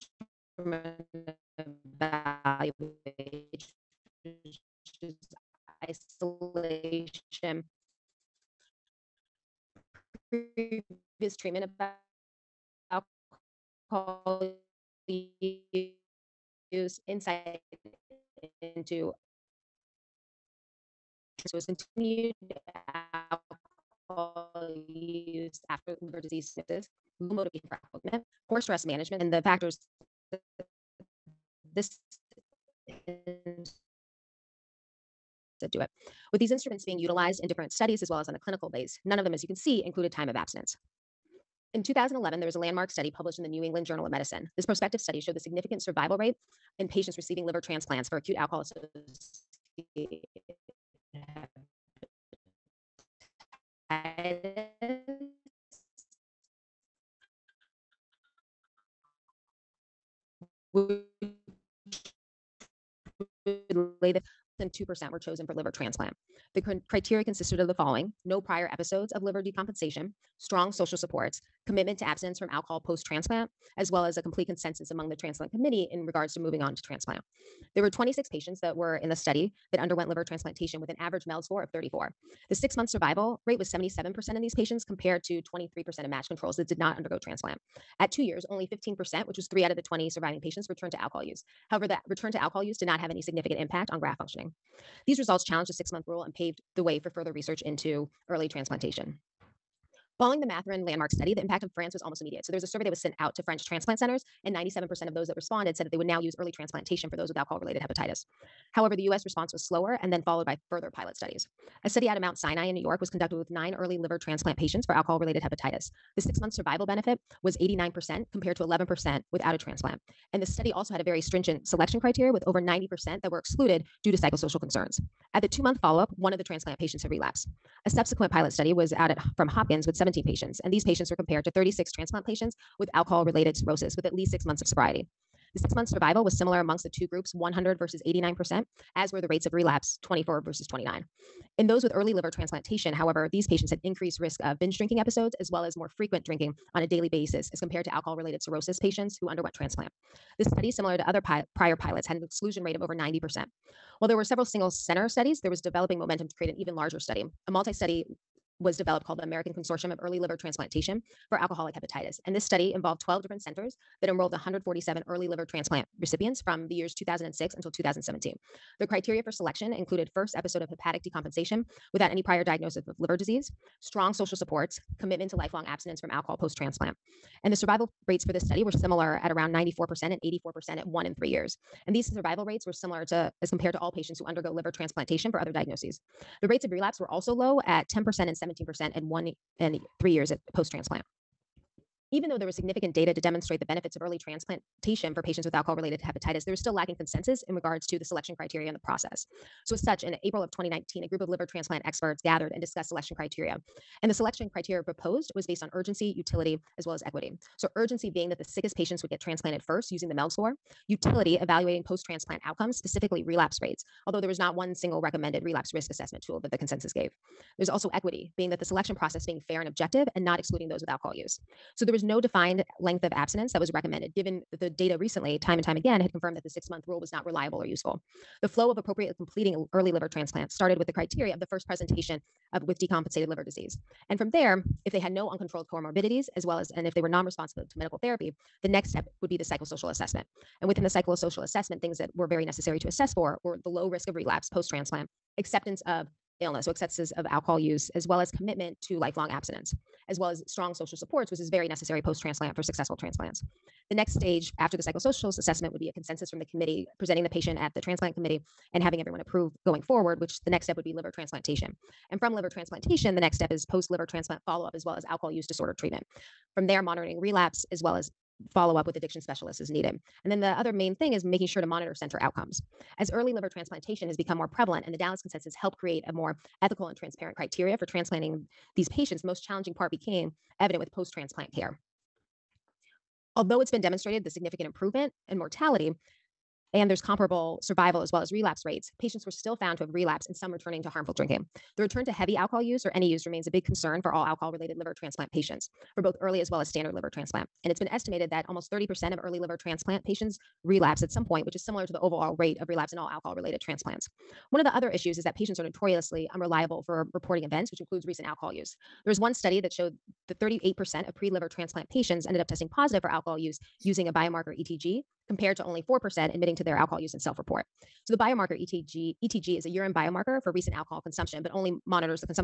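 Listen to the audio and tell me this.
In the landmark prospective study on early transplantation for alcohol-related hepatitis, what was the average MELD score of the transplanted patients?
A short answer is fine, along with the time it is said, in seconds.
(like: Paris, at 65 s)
34, at 81 s.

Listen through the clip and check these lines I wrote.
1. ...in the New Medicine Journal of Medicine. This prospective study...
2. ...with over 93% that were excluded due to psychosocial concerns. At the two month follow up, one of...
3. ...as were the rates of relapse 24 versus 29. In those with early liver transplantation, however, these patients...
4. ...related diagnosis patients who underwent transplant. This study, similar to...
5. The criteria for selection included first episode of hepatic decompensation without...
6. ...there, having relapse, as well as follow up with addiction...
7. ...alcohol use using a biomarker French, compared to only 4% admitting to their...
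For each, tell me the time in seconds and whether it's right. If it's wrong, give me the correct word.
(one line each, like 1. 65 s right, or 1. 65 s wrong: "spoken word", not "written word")
1. 43 s wrong: "England", not "Medicine"
2. 122 s wrong: "90", not "93"
3. 138 s right
4. 148 s wrong: "cirrhosis", not "diagnosis"
5. 168 s right
6. 266 s wrong: "monitoring", not "having"
7. 313 s wrong: "ETG", not "French".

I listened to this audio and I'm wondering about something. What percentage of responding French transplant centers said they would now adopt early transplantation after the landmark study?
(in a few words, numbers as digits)
97%.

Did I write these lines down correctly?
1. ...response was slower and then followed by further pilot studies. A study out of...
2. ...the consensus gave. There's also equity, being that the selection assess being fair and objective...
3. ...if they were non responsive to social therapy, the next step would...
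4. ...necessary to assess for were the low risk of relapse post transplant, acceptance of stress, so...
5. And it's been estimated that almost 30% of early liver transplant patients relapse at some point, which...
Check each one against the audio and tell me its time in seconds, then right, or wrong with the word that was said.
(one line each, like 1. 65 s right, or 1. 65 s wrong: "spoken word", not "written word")
1. 109 s right
2. 216 s wrong: "process", not "assess"
3. 236 s wrong: "medical", not "social"
4. 242 s wrong: "illness", not "stress"
5. 297 s right.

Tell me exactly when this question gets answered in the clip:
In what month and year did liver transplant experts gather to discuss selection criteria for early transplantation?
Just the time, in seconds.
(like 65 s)
200 s.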